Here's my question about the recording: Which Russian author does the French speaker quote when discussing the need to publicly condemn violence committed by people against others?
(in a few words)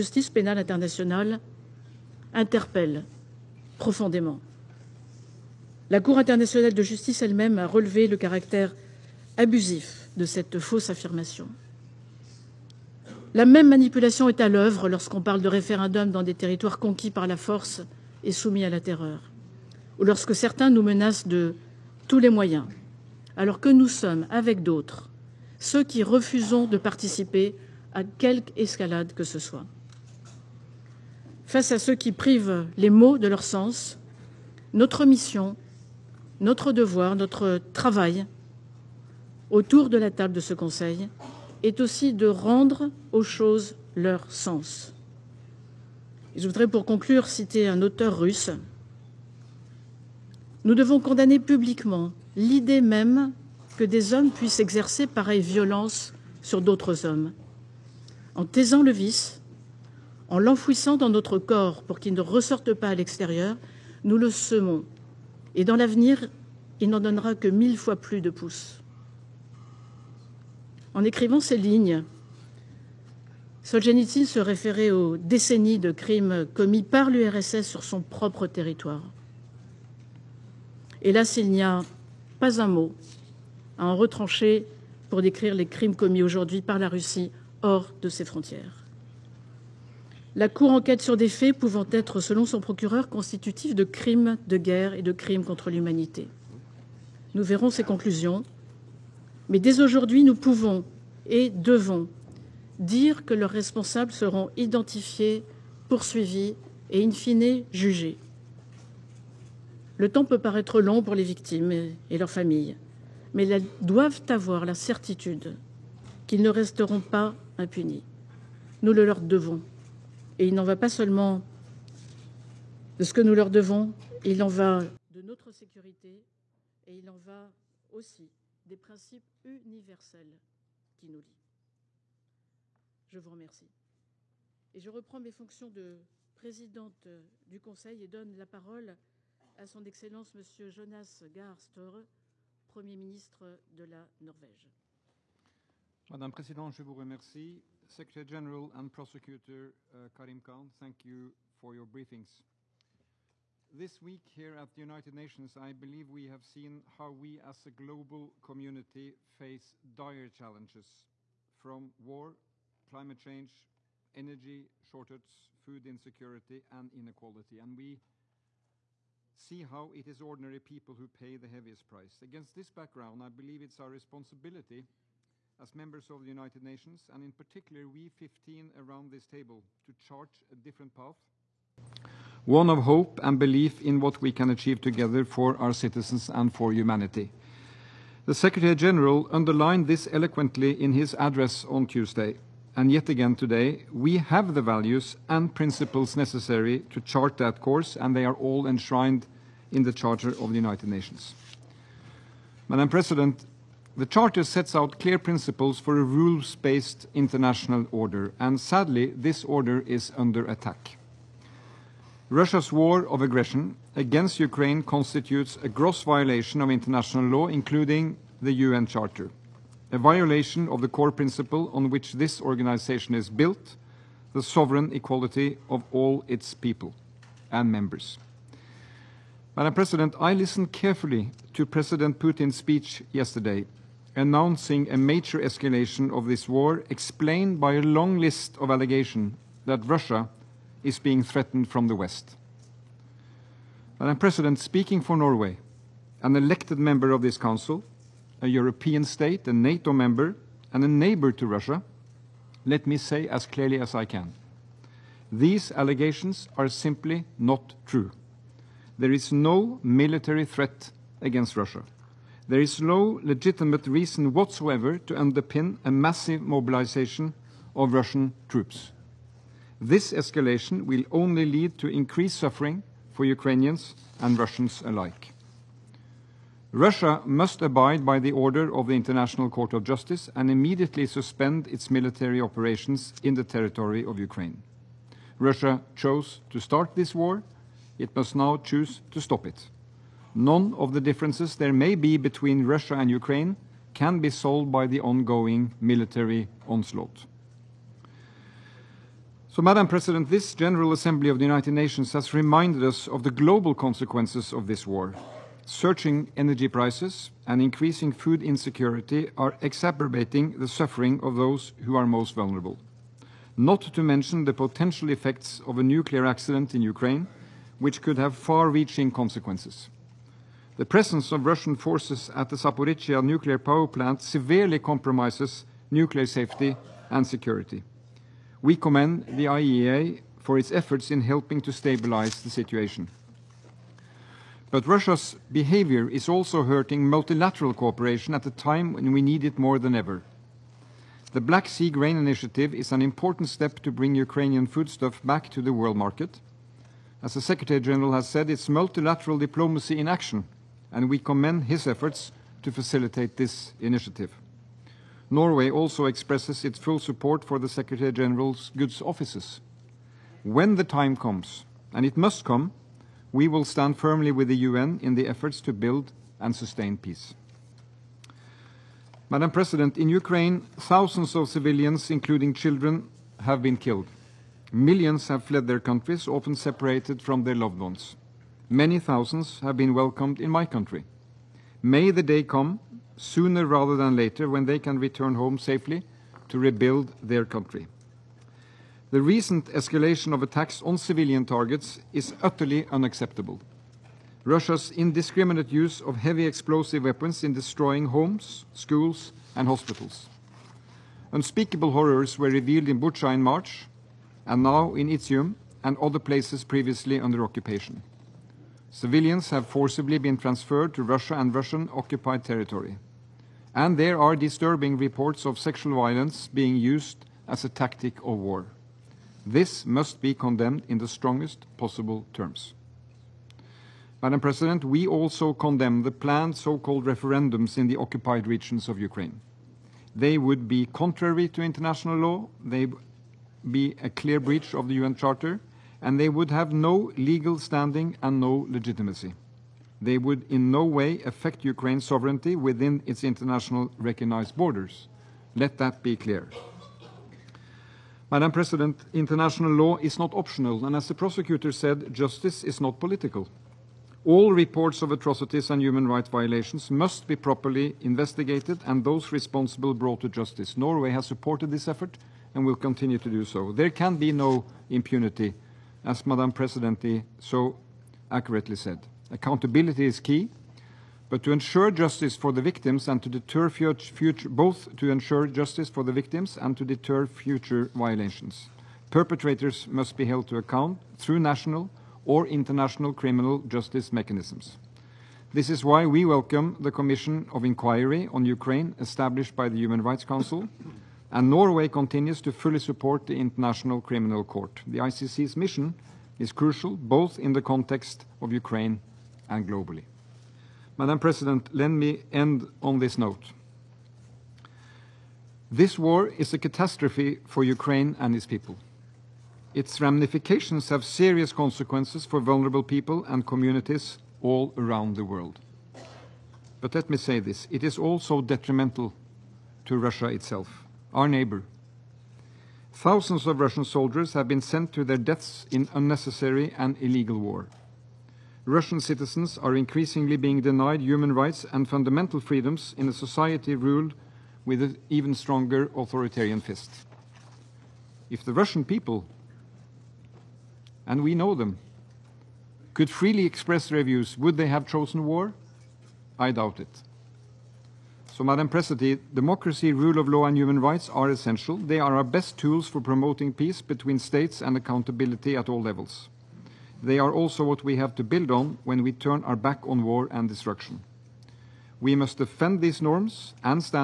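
Solzhenitsyn.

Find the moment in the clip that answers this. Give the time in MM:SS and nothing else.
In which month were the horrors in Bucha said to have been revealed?
06:43.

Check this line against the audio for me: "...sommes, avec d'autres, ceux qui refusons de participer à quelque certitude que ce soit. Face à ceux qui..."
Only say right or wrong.
wrong.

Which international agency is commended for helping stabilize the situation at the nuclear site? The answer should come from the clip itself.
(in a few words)
IAEA.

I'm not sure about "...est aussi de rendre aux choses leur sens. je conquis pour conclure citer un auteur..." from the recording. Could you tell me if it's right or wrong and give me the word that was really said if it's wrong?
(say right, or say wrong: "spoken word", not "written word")
wrong: "voudrais", not "conquis".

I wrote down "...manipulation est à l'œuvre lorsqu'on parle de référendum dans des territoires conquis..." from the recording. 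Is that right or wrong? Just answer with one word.
right.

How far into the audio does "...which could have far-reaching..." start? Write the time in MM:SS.
05:17.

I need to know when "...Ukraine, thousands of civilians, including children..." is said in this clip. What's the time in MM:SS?
06:10.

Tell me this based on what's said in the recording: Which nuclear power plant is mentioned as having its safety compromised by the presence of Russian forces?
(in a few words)
Zaporizhia.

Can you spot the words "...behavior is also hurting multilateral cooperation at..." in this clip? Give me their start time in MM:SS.
05:35.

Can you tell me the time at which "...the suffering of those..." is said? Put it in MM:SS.
05:10.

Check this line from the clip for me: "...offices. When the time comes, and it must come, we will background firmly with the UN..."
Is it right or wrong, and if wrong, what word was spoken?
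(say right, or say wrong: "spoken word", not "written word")
wrong: "stand", not "background".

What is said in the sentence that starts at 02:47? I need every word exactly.
And we see how it is ordinary people who pay the heaviest price.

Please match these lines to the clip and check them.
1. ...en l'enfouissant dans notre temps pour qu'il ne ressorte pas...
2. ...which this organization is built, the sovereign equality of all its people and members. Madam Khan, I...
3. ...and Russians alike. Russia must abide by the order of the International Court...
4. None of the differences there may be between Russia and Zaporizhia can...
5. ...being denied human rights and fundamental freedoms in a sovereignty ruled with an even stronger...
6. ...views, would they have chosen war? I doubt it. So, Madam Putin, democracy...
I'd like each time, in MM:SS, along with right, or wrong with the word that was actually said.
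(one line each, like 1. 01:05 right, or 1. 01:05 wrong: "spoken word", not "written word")
1. 01:00 wrong: "corps", not "temps"
2. 03:41 wrong: "President", not "Khan"
3. 04:34 right
4. 04:50 wrong: "Ukraine", not "Zaporizhia"
5. 08:50 wrong: "society", not "sovereignty"
6. 09:04 wrong: "President", not "Putin".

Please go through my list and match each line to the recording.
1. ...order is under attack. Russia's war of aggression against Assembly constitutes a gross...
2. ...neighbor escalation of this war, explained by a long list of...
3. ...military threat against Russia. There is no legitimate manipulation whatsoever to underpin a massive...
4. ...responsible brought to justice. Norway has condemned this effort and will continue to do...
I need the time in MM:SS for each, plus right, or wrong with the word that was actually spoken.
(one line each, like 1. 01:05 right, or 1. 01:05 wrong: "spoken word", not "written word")
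1. 03:29 wrong: "Ukraine", not "Assembly"
2. 03:54 wrong: "major", not "neighbor"
3. 04:19 wrong: "reason", not "manipulation"
4. 07:39 wrong: "supported", not "condemned".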